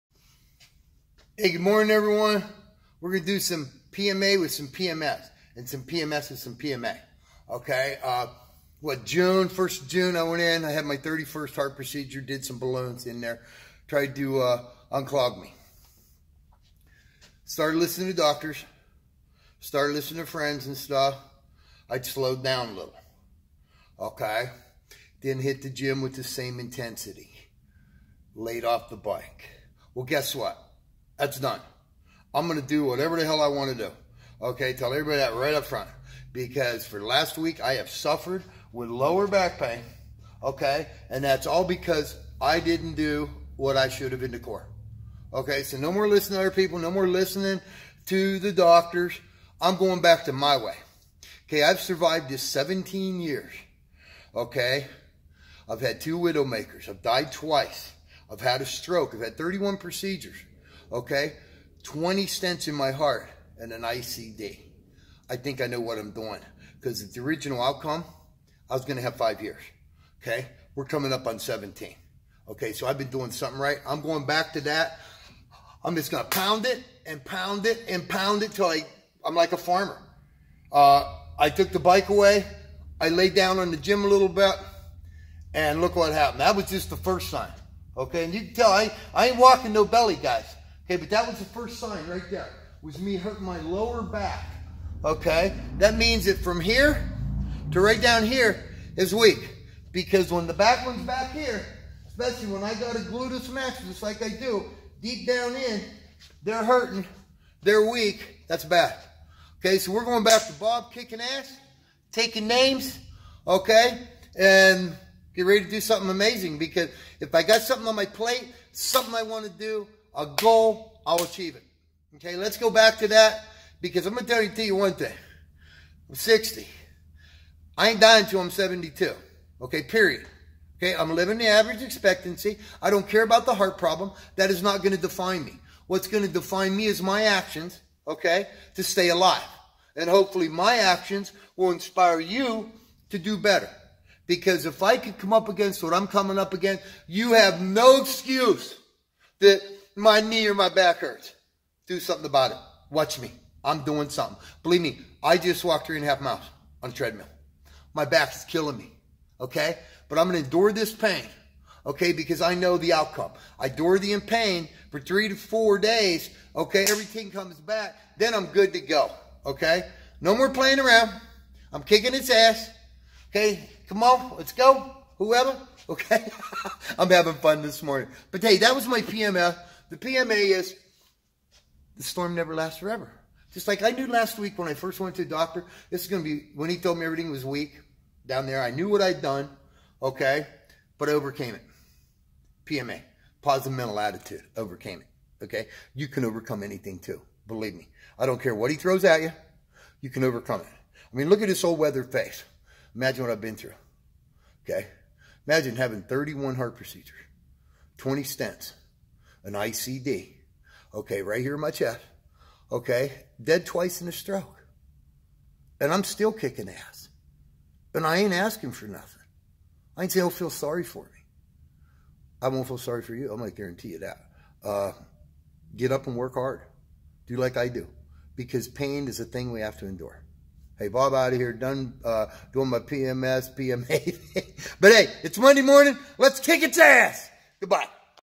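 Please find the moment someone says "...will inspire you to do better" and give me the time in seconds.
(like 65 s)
141 s.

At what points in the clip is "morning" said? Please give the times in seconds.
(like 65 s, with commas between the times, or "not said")
1 s, 177 s, 235 s.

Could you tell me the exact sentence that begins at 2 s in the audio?
We're going to do some PMA with some PMS and some PMS with some PMA.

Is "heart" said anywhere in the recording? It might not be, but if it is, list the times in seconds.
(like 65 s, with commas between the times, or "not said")
11 s, 62 s, 133 s, 206 s.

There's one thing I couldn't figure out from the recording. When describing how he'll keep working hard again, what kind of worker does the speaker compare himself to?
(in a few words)
a farmer.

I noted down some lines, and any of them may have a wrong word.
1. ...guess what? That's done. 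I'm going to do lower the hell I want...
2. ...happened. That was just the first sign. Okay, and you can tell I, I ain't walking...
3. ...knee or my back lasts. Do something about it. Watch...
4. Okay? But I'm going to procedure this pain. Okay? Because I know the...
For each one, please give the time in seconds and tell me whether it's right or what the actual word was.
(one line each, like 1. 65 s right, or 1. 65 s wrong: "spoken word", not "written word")
1. 30 s wrong: "whatever", not "lower"
2. 86 s right
3. 150 s wrong: "hurts", not "lasts"
4. 159 s wrong: "endure", not "procedure".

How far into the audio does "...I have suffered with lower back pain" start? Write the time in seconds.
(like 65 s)
37 s.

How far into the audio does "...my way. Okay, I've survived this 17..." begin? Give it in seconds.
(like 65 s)
50 s.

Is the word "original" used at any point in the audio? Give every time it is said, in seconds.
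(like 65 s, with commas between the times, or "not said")
67 s.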